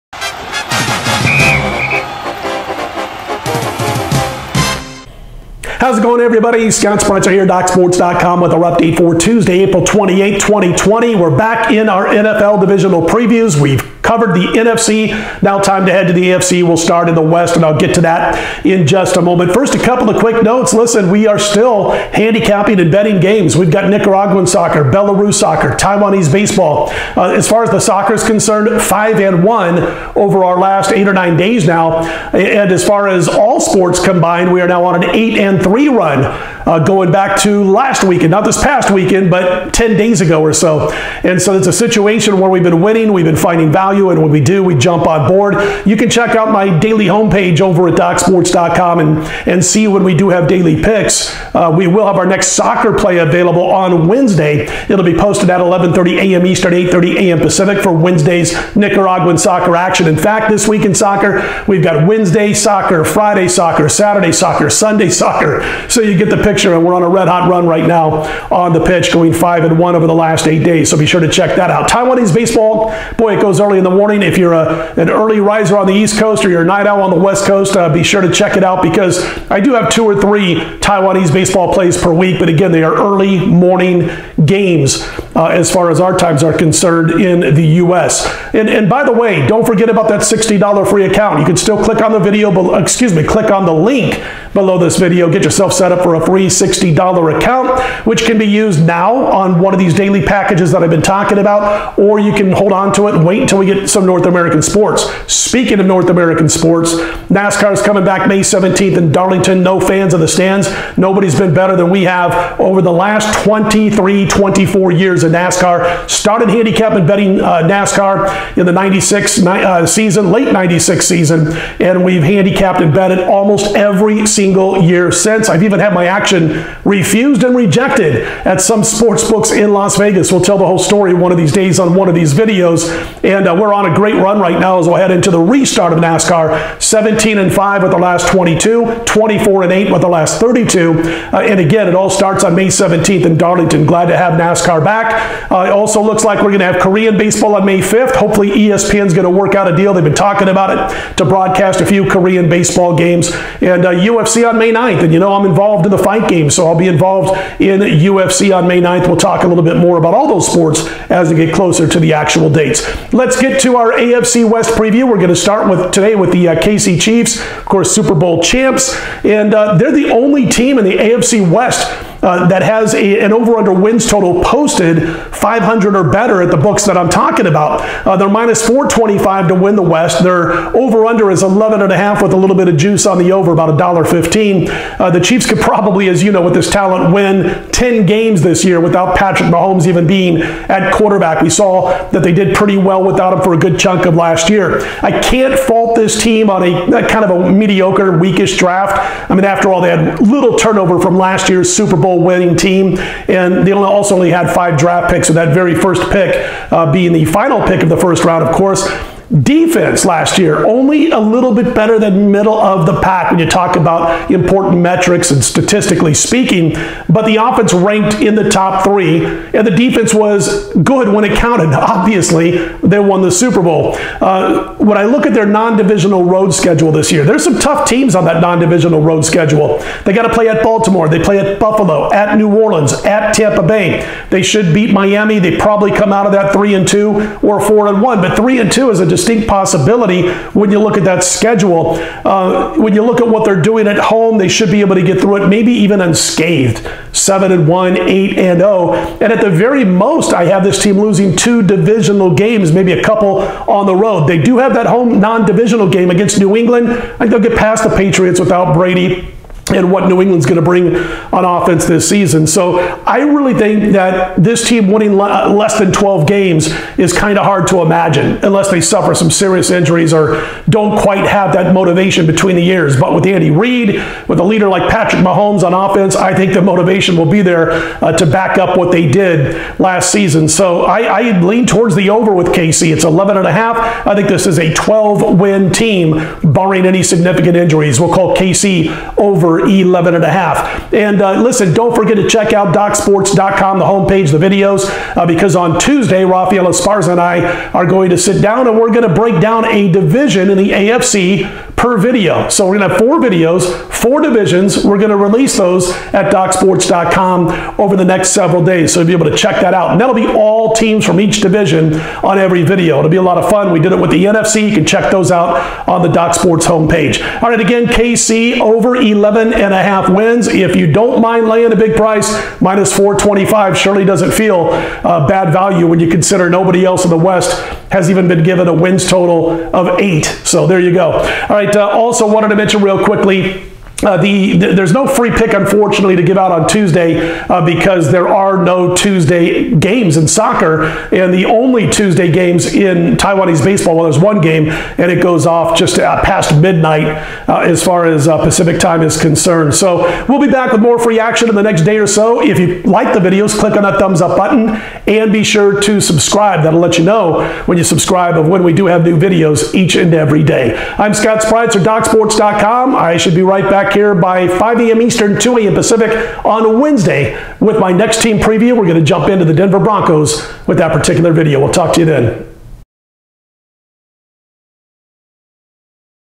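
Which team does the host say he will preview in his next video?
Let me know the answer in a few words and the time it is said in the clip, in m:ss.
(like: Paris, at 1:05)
Denver Broncos, at 6:09.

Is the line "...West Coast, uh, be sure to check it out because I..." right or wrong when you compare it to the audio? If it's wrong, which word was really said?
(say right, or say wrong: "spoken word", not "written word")
right.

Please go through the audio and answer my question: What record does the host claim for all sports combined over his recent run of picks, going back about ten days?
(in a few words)
8-3.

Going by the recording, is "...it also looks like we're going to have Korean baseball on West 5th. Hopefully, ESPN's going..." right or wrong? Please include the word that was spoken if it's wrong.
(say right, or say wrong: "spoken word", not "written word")
wrong: "May", not "West".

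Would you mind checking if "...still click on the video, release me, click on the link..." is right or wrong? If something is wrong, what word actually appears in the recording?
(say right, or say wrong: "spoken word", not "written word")
wrong: "excuse", not "release".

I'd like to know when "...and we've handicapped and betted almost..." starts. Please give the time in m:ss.
2:01.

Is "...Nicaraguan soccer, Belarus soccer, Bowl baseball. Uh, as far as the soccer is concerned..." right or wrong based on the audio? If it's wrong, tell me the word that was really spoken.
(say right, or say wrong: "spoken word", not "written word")
wrong: "Taiwanese", not "Bowl".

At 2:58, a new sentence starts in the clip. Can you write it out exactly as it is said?
Uh, they're minus 425 to win the West.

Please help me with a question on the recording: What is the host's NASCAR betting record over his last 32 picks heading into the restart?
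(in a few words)
24-8.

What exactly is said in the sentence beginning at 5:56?
That'll let you know when you subscribe of when we do have new videos each and every day.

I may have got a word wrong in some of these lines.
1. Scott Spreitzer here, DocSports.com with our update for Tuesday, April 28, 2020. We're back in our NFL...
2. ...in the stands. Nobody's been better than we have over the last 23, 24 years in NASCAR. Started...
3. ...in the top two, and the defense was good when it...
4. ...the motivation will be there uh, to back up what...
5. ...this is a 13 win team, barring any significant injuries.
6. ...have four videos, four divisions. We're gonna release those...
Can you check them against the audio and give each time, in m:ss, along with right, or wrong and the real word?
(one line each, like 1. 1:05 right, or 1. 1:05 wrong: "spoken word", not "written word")
1. 0:06 right
2. 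1:50 right
3. 3:38 wrong: "three", not "two"
4. 4:36 right
5. 4:44 wrong: "12", not "13"
6. 5:02 right.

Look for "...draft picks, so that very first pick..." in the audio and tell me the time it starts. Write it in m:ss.
3:24.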